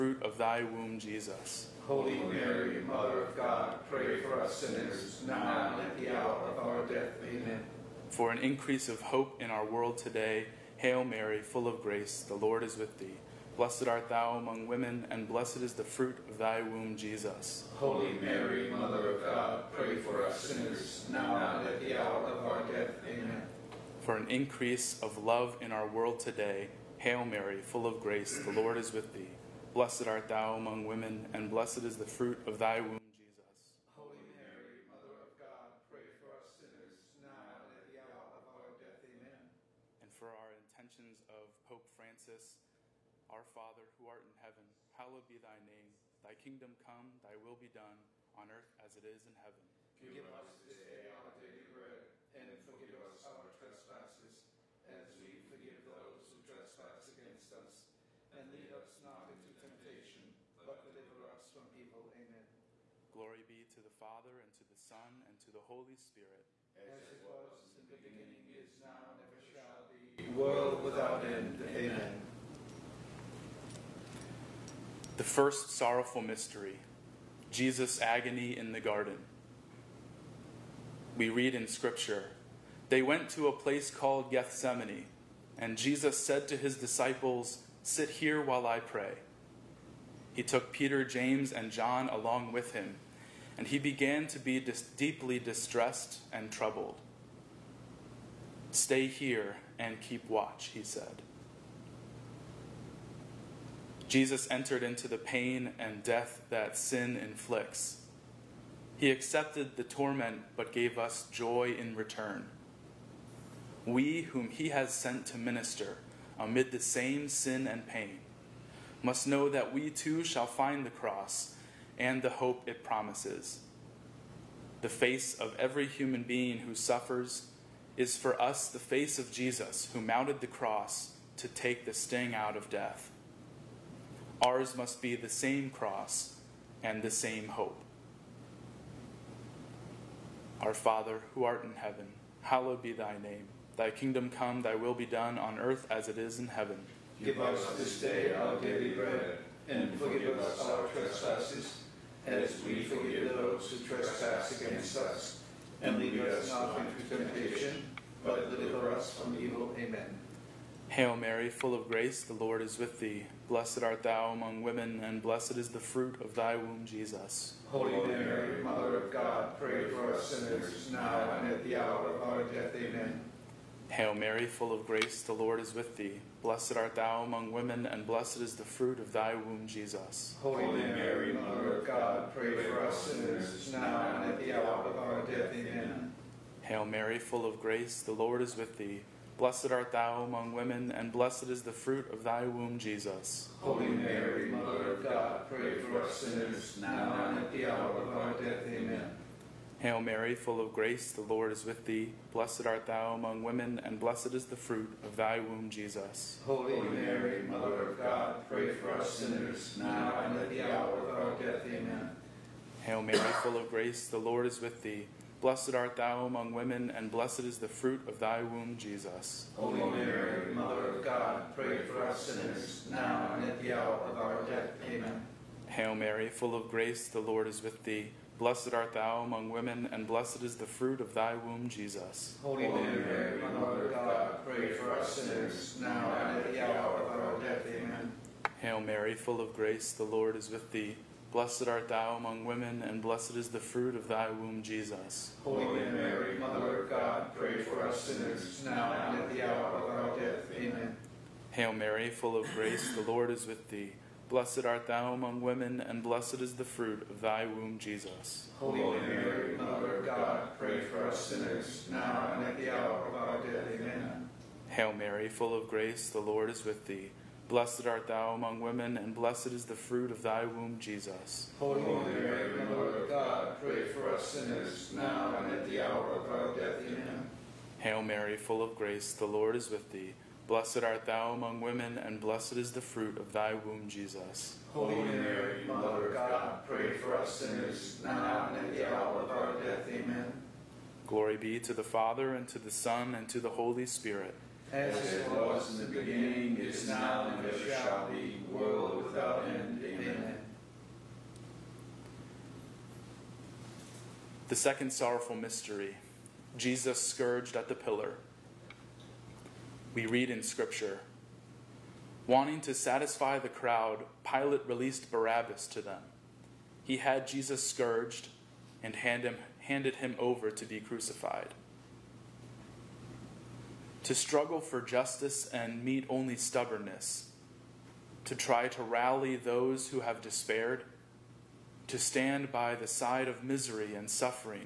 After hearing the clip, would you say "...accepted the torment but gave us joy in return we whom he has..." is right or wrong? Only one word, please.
right.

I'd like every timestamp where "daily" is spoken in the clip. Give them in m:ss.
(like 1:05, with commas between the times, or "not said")
0:51, 2:28.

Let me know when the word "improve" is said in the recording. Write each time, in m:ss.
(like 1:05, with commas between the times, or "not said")
not said.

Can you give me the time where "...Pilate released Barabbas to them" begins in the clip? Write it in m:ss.
5:14.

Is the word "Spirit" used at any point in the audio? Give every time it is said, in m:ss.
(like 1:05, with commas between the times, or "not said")
1:05, 4:53.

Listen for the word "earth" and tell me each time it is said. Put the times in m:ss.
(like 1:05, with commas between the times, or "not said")
0:48, 2:25.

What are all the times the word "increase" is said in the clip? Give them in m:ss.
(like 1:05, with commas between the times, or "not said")
0:08, 0:24.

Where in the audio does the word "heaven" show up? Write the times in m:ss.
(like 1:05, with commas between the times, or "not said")
0:44, 0:49, 2:21, 2:26.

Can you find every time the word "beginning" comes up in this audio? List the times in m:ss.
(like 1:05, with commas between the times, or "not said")
1:07, 4:55.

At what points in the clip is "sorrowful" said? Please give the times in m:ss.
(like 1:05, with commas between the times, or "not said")
1:15, 5:04.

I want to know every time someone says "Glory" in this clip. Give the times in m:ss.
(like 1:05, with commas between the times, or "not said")
1:03, 4:51.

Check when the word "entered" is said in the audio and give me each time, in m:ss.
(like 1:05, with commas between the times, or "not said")
1:44.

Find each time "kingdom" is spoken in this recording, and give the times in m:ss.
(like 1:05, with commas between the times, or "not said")
0:46, 2:23.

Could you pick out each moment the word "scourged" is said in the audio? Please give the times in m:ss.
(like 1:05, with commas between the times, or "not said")
5:07, 5:17.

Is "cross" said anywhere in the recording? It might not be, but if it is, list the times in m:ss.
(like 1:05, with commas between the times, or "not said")
2:00, 2:10, 2:15.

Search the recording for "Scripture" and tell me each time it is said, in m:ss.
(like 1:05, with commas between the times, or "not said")
1:21, 5:10.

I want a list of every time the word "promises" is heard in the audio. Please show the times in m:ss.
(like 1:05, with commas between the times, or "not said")
2:02.